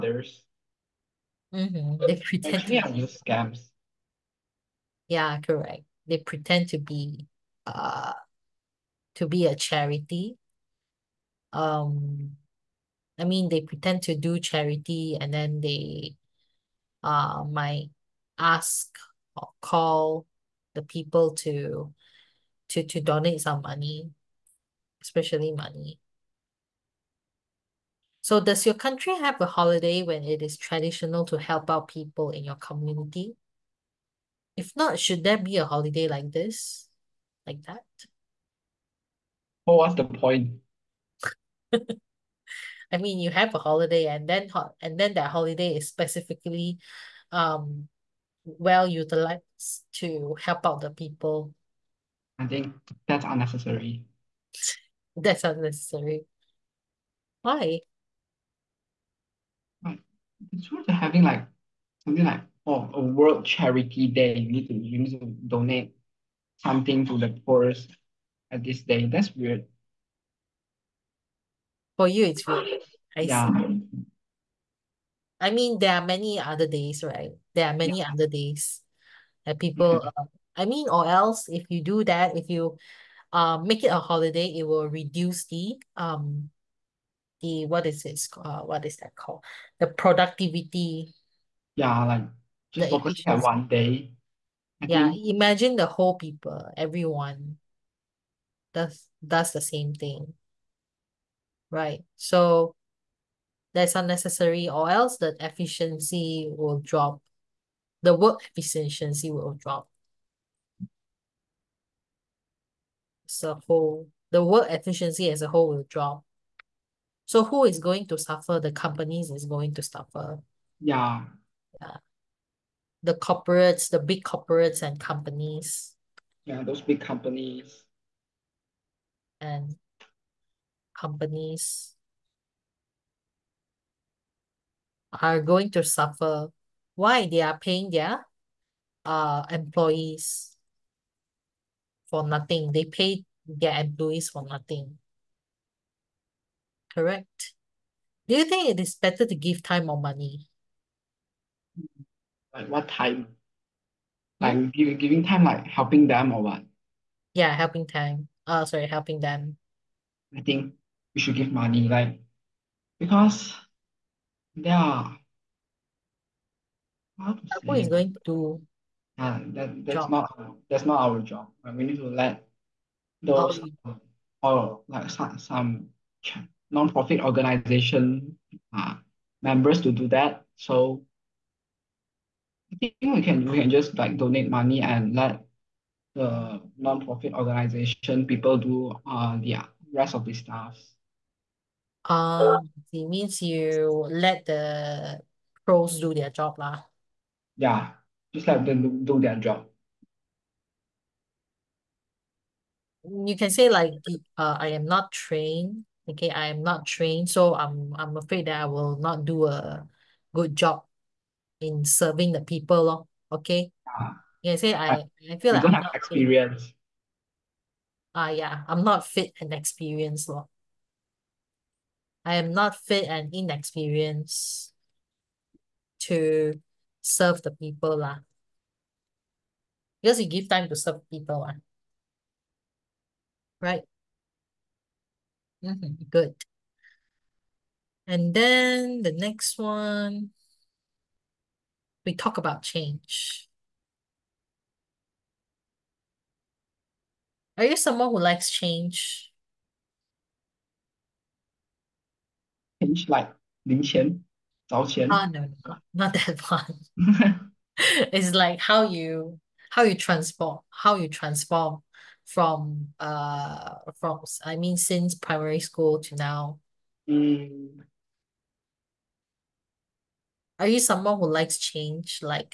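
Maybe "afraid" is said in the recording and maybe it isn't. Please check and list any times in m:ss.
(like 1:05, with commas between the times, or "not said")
3:28.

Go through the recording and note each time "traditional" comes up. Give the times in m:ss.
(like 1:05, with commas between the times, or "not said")
0:30.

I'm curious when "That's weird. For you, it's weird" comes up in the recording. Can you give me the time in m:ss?
1:09.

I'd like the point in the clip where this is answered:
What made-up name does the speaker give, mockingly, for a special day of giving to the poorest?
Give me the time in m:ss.
1:03.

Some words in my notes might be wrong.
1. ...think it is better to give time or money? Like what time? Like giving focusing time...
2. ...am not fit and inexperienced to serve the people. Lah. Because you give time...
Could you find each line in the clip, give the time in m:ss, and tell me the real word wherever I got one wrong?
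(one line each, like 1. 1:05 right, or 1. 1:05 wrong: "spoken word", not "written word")
1. 2:28 wrong: "giving", not "focusing"
2. 3:42 right.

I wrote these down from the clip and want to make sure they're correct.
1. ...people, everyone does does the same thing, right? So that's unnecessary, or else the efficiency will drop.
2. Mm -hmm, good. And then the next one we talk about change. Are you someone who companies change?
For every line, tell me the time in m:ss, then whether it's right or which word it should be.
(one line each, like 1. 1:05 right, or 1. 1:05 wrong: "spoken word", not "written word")
1. 1:36 right
2. 3:55 wrong: "likes", not "companies".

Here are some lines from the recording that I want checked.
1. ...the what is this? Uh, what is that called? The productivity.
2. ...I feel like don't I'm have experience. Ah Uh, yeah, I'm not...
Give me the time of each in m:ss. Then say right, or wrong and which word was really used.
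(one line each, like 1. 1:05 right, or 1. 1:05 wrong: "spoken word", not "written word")
1. 1:27 right
2. 3:35 right.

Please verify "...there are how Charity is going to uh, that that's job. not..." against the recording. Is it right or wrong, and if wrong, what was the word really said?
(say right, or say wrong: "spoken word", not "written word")
wrong: "Who", not "Charity".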